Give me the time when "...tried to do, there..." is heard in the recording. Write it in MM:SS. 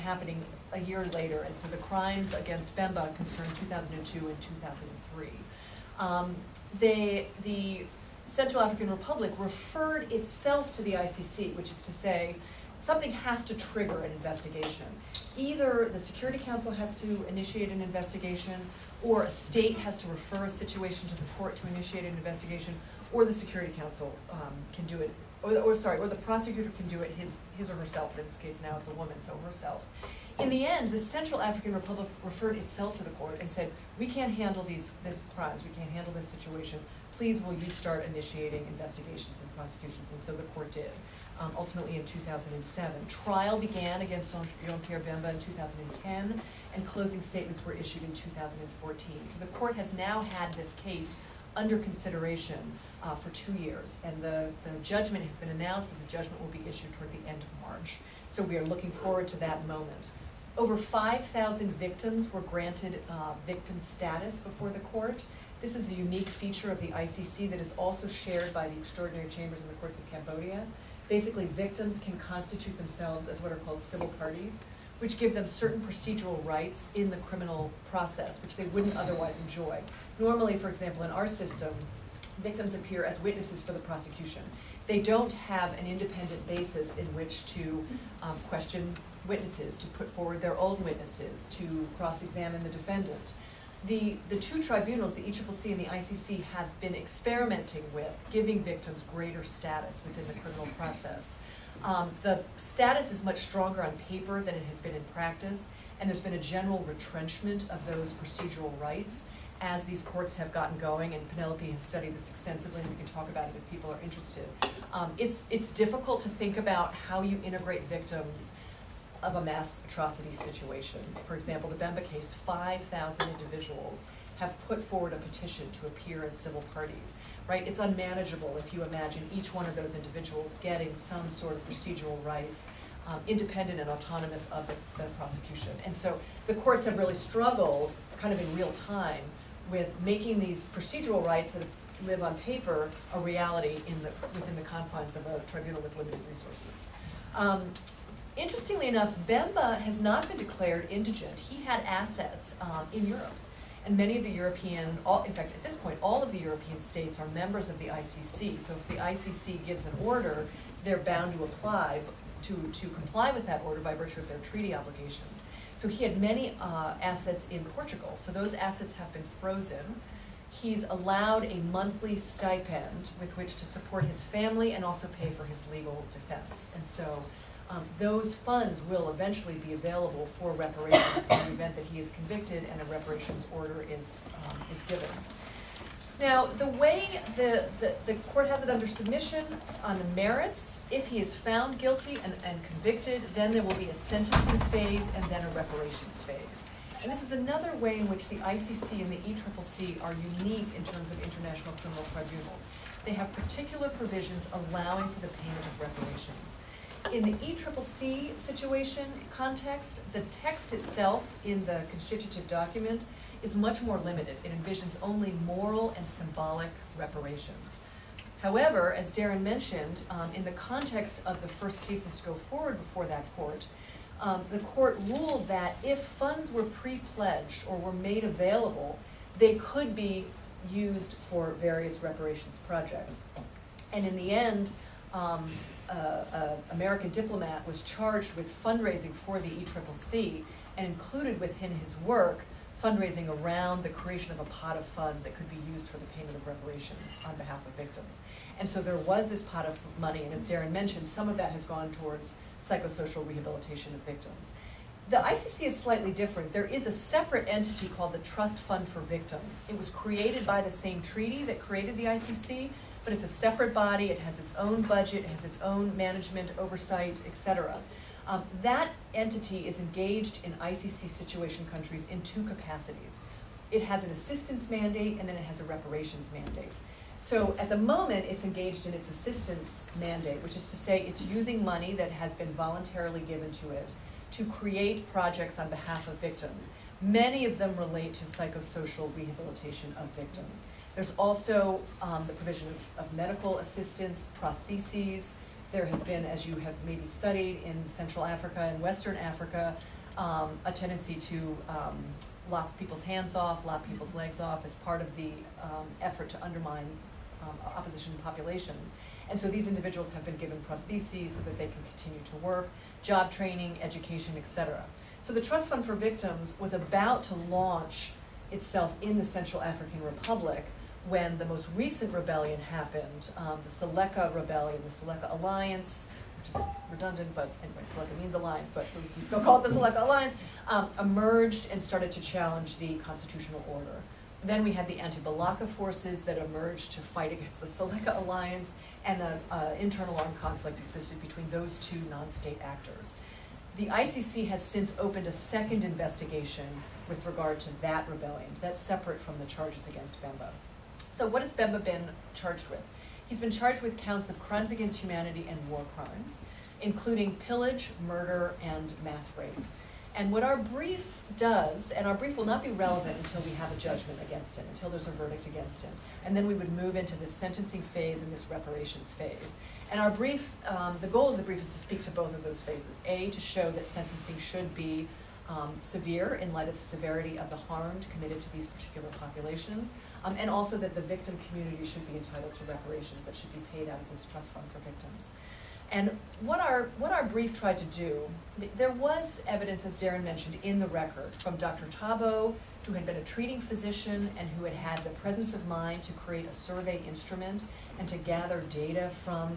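06:27.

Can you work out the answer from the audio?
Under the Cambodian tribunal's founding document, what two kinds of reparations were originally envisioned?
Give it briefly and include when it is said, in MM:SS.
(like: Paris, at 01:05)
Moral and symbolic, at 03:35.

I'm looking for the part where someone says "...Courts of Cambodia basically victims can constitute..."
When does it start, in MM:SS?
01:09.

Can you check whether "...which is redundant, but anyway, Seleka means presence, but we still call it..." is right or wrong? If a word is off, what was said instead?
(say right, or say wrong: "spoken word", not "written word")
wrong: "alliance", not "presence".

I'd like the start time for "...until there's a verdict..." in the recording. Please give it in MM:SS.
06:04.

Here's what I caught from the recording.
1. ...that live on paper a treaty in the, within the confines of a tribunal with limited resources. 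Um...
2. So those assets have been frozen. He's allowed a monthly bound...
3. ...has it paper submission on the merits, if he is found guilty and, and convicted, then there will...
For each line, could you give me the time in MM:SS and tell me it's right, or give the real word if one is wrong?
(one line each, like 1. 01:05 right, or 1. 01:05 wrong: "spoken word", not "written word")
1. 02:21 wrong: "reality", not "treaty"
2. 02:48 wrong: "stipend", not "bound"
3. 03:08 wrong: "under", not "paper".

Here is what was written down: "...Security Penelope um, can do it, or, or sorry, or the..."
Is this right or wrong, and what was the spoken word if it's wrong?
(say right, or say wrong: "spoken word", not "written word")
wrong: "Council", not "Penelope".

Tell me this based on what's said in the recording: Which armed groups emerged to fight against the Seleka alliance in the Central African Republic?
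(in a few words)
Anti-Balaka forces.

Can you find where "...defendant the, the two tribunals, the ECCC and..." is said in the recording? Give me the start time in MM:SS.
01:32.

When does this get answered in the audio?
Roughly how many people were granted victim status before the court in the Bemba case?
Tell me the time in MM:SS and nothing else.
01:00.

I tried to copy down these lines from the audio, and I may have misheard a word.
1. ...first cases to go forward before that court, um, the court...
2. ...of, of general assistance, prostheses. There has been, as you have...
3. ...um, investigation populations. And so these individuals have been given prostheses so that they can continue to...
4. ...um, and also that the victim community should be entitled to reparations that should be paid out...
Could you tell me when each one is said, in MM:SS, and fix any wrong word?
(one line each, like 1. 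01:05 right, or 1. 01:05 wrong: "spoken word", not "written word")
1. 03:41 right
2. 04:52 wrong: "medical", not "general"
3. 05:07 wrong: "opposition", not "investigation"
4. 06:20 right.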